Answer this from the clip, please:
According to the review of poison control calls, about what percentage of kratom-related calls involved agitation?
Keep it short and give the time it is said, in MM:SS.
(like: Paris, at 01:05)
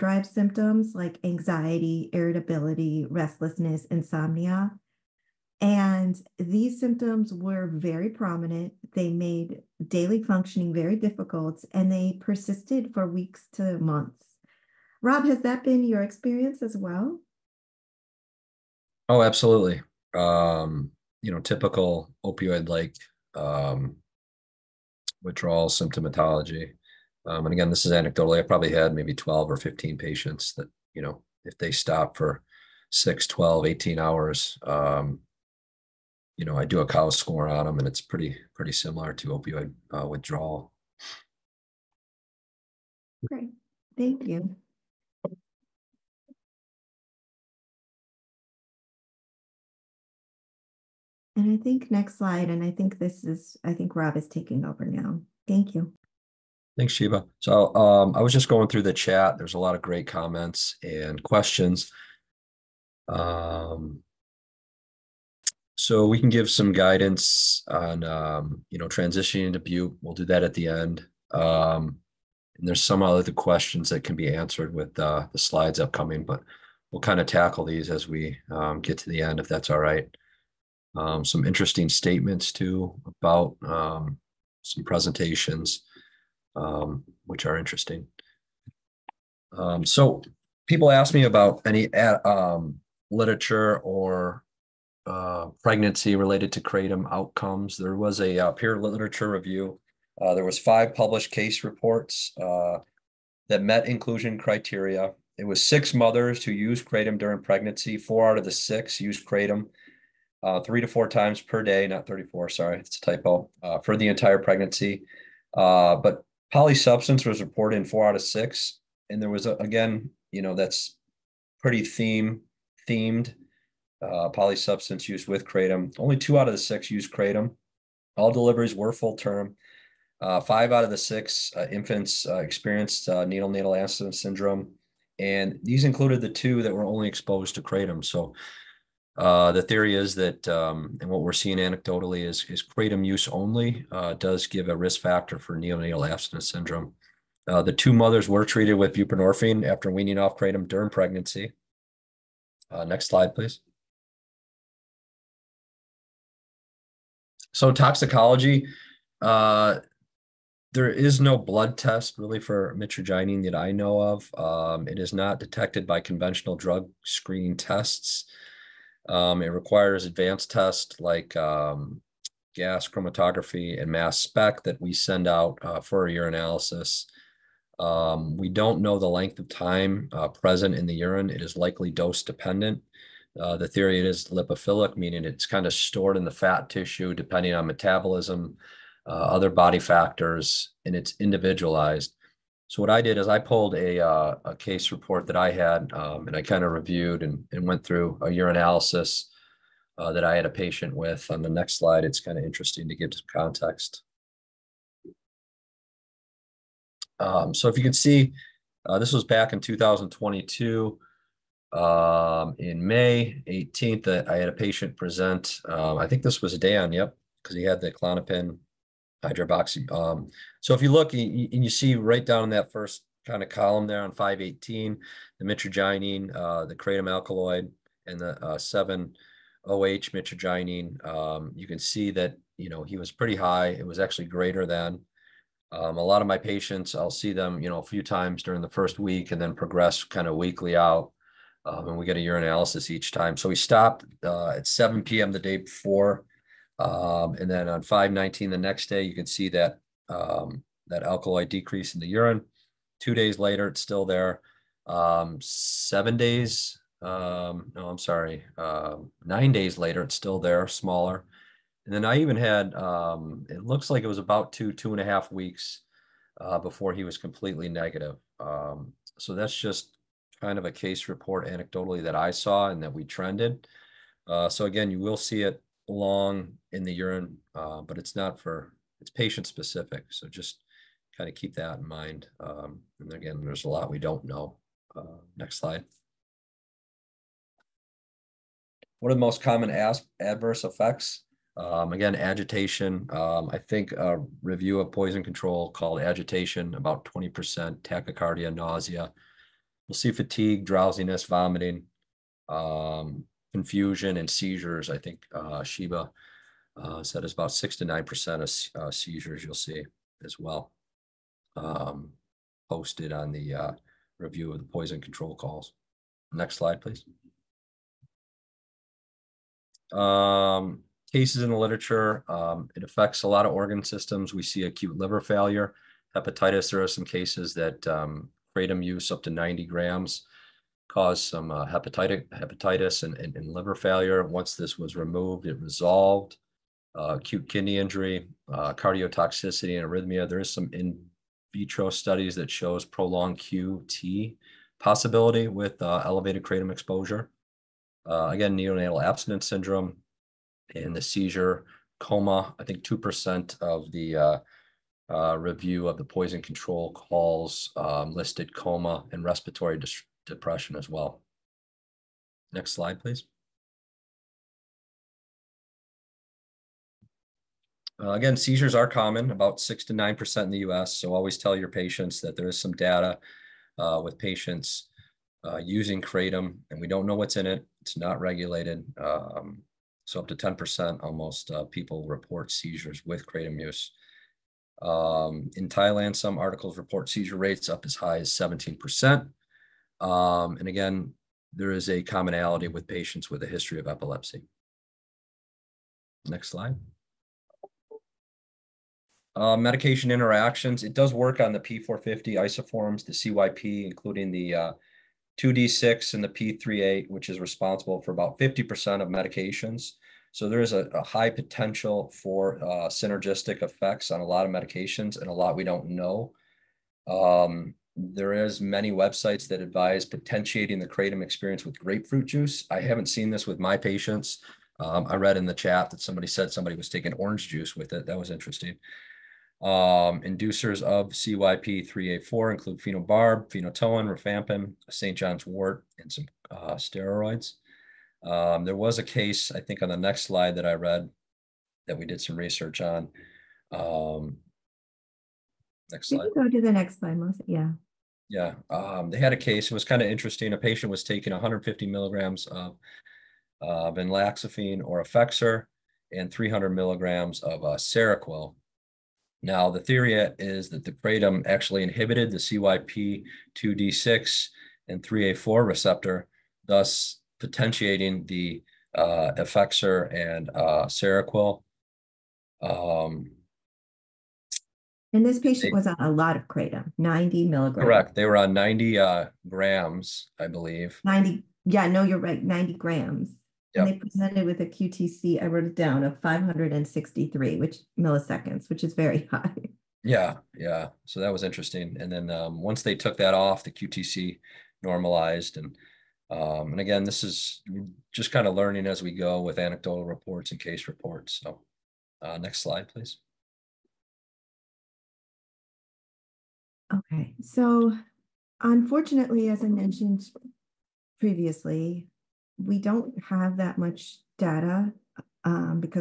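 20%, at 04:57.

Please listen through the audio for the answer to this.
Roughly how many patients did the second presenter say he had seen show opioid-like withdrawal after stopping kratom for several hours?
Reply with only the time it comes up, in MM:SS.
00:29.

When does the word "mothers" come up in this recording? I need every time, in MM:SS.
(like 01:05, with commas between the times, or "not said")
01:45, 02:27.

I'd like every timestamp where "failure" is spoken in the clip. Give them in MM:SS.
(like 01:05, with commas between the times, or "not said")
05:25, 05:33.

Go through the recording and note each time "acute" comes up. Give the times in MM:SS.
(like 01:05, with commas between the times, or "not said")
05:24, 05:37.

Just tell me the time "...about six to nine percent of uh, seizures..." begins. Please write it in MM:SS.
05:07.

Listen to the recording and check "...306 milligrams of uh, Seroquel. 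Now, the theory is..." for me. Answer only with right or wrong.
wrong.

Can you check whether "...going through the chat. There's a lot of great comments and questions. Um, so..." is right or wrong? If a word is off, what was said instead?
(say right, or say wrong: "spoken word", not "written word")
right.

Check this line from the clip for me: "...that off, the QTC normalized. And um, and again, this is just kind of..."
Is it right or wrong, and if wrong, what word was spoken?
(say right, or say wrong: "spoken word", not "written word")
right.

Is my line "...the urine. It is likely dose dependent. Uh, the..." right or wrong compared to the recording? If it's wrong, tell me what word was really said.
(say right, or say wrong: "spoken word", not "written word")
right.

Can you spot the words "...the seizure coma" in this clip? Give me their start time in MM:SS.
05:50.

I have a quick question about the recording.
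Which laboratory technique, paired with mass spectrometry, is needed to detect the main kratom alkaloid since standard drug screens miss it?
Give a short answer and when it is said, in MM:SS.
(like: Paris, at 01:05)
gas chromatography, at 02:52.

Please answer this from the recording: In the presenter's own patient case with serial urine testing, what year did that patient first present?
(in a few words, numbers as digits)
2022.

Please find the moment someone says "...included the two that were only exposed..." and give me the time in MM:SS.
02:15.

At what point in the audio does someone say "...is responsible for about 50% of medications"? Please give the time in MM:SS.
06:47.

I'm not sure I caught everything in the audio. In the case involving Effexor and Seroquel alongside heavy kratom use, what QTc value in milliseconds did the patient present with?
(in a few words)
563.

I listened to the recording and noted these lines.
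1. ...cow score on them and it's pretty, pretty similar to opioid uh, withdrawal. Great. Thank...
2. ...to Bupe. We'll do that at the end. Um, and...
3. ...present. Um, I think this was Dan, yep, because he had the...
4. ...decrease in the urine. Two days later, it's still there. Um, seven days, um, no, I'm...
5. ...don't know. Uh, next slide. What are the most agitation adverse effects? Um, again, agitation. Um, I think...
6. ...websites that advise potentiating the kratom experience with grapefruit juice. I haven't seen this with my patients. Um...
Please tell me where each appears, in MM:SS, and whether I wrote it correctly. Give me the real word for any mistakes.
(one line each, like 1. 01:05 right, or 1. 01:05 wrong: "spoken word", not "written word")
1. 00:36 right
2. 01:09 right
3. 03:34 right
4. 04:11 right
5. 04:43 wrong: "common", not "agitation"
6. 06:58 right.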